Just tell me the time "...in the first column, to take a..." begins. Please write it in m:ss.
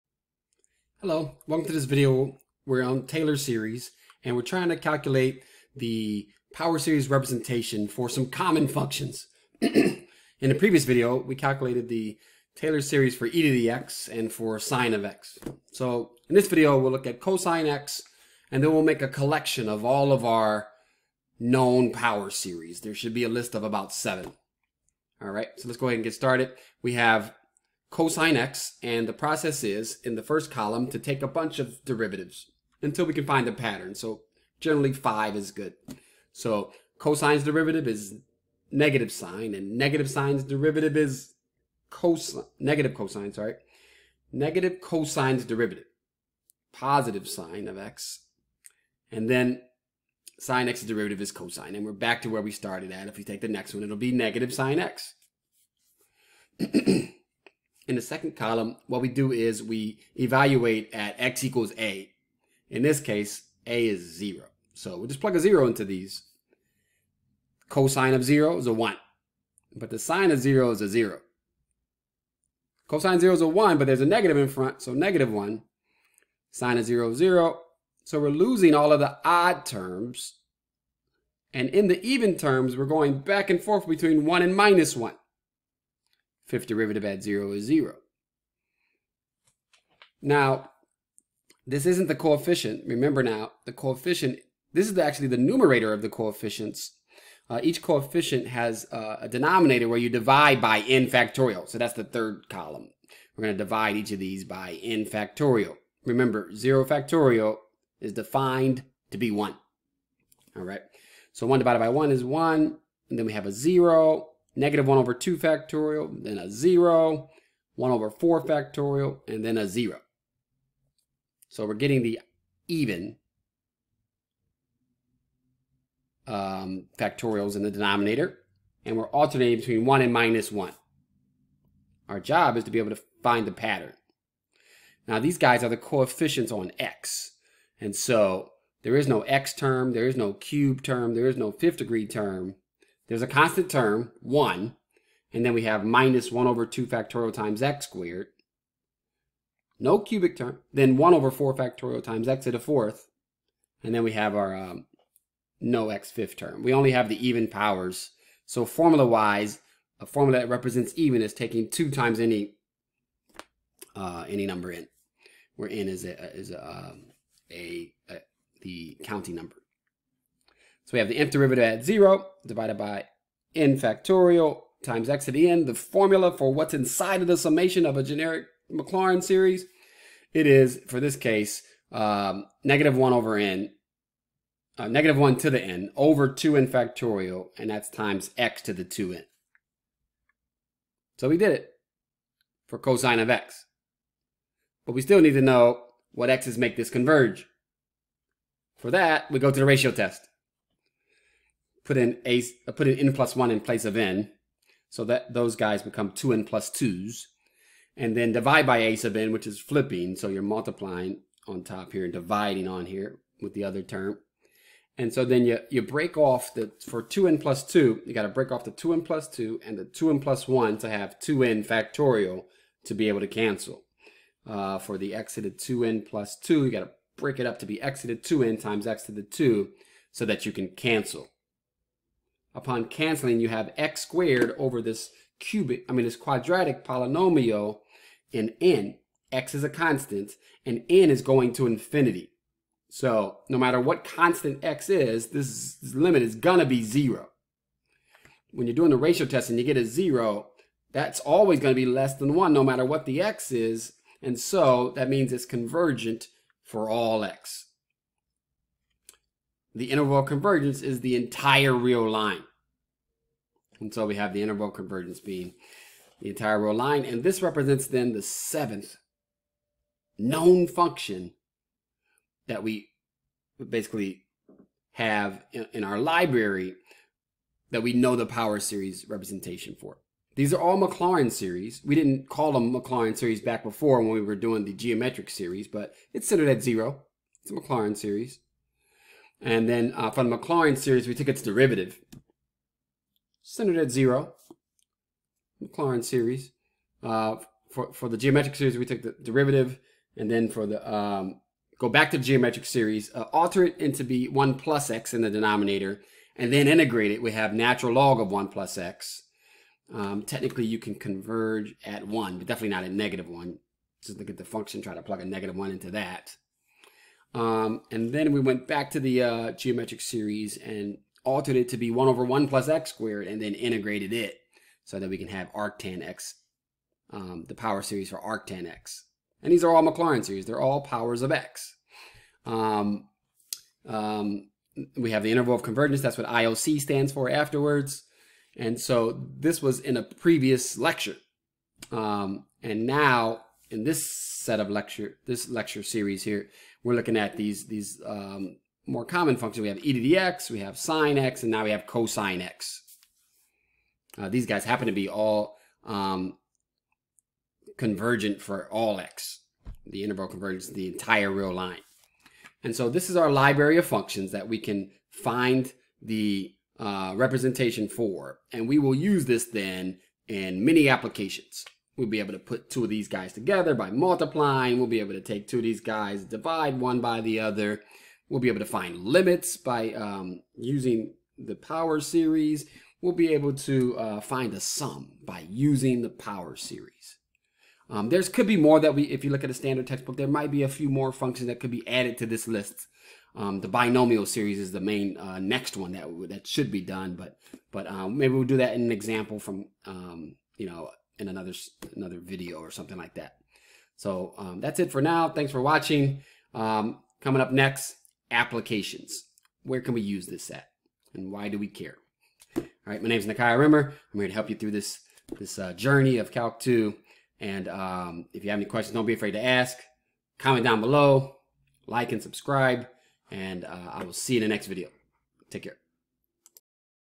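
0:30.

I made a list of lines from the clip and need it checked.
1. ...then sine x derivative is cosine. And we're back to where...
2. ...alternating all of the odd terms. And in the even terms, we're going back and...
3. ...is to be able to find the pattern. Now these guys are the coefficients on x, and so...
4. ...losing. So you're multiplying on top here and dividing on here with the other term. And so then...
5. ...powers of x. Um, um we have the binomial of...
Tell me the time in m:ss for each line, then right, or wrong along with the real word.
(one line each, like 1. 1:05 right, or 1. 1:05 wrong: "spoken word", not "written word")
1. 0:49 right
2. 1:18 wrong: "losing", not "alternating"
3. 2:12 right
4. 3:29 wrong: "flipping", not "losing"
5. 5:30 wrong: "interval", not "binomial".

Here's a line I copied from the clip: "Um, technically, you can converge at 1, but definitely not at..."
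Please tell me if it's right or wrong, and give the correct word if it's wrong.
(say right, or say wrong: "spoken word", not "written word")
right.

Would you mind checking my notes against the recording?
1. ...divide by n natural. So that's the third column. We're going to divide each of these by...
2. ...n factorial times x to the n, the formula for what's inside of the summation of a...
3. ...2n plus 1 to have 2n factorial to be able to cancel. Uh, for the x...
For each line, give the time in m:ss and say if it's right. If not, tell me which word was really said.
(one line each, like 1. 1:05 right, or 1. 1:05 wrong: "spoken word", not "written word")
1. 1:40 wrong: "factorial", not "natural"
2. 2:53 right
3. 3:39 right.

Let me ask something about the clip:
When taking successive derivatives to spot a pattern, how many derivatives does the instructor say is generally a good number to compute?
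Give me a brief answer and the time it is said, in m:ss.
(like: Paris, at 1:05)
5, at 0:34.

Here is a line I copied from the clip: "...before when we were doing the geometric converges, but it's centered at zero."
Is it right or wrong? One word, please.
wrong.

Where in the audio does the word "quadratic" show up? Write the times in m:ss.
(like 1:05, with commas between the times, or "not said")
3:56.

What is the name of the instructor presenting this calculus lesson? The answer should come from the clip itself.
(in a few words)
Nakia Rimmer.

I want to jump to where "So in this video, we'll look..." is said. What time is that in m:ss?
0:15.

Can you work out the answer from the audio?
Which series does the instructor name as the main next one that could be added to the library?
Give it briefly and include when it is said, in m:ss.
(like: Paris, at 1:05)
binomial series, at 6:33.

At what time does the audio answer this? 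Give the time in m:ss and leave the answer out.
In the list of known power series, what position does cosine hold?
4:28.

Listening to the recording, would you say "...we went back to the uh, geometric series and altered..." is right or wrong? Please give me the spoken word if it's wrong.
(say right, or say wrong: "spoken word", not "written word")
right.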